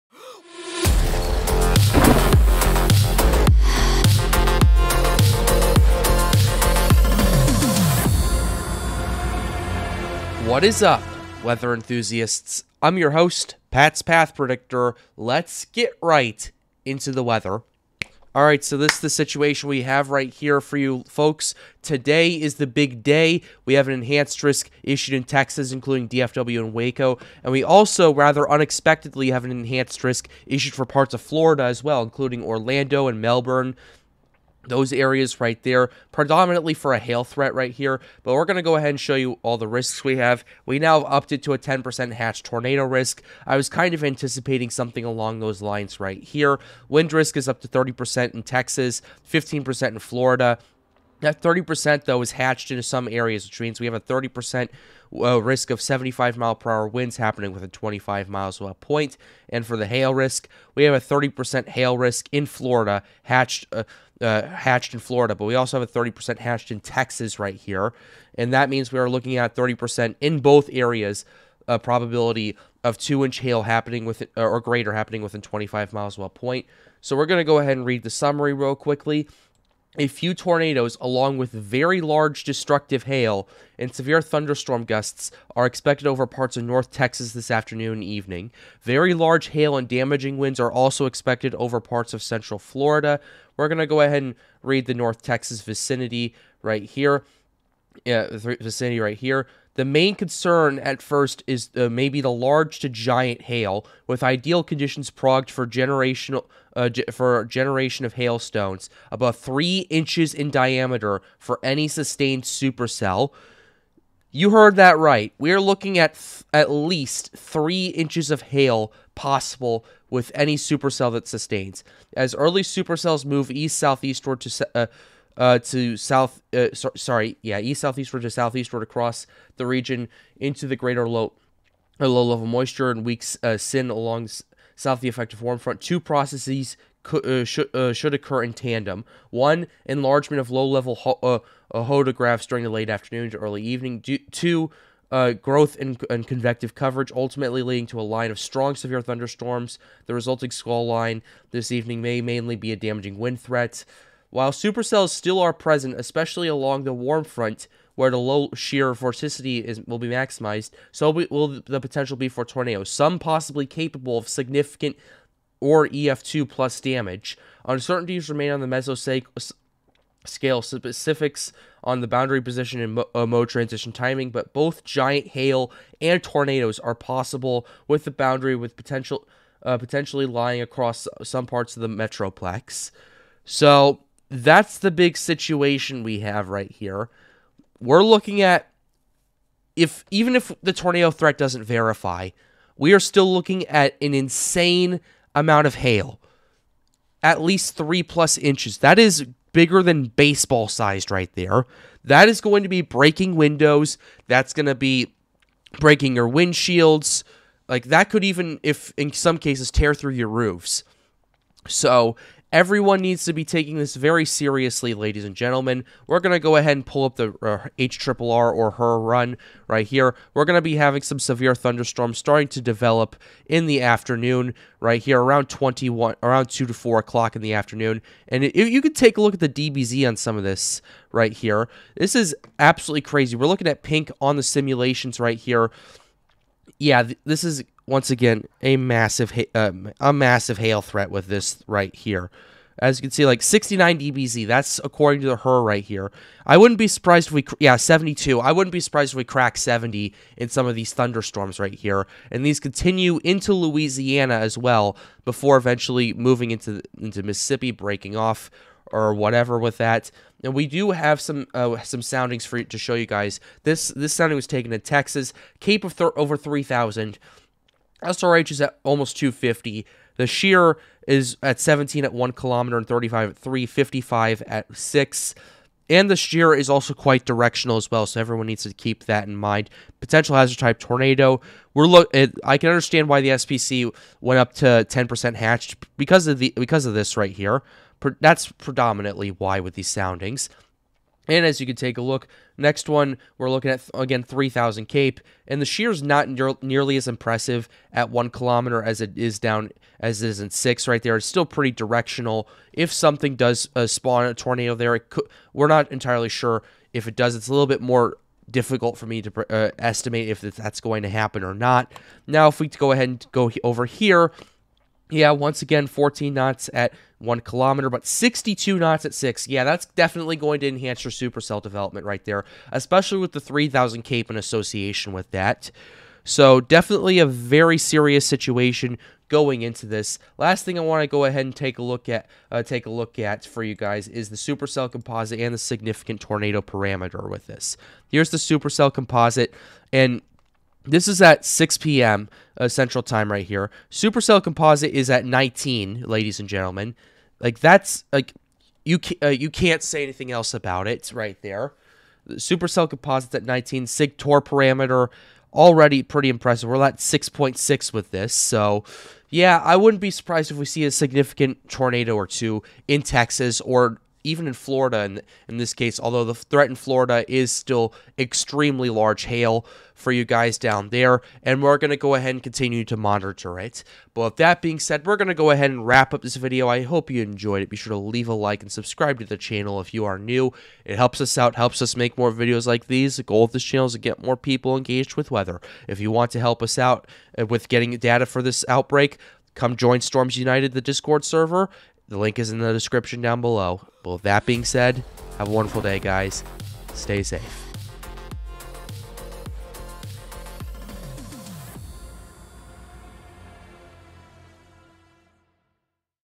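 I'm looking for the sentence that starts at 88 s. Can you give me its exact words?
Very large hail and damaging winds are also expected over parts of central Florida.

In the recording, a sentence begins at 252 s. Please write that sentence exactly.
And these continue into Louisiana as well before eventually moving into, into Mississippi, breaking off or whatever with that.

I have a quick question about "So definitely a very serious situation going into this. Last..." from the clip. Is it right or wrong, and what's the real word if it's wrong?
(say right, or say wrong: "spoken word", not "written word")
right.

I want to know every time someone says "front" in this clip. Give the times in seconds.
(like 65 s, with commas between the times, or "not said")
135 s, 157 s.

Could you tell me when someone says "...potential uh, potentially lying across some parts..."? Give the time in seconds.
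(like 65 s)
178 s.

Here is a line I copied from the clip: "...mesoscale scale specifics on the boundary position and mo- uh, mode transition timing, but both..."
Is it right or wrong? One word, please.
right.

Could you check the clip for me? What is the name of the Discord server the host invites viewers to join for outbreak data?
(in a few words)
Storms United.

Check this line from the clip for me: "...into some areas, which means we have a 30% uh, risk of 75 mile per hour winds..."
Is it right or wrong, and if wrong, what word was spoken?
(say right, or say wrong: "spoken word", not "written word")
right.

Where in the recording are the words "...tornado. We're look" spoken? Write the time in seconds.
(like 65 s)
280 s.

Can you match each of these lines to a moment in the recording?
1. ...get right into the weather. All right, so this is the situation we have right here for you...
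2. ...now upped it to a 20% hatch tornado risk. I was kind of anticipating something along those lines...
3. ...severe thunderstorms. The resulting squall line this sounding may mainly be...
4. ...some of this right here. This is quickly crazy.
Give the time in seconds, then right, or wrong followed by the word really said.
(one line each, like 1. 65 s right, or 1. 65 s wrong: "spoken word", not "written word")
1. 15 s right
2. 40 s wrong: "10", not "20"
3. 148 s wrong: "evening", not "sounding"
4. 230 s wrong: "absolutely", not "quickly".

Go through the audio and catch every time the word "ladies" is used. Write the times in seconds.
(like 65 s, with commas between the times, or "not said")
214 s, 346 s.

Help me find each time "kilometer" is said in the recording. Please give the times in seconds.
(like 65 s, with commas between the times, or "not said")
272 s, 298 s, 317 s.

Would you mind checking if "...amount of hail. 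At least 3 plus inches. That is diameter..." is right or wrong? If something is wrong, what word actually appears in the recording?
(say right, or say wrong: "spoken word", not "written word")
wrong: "bigger", not "diameter".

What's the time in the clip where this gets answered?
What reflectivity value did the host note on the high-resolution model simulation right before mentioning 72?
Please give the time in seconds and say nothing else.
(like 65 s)
243 s.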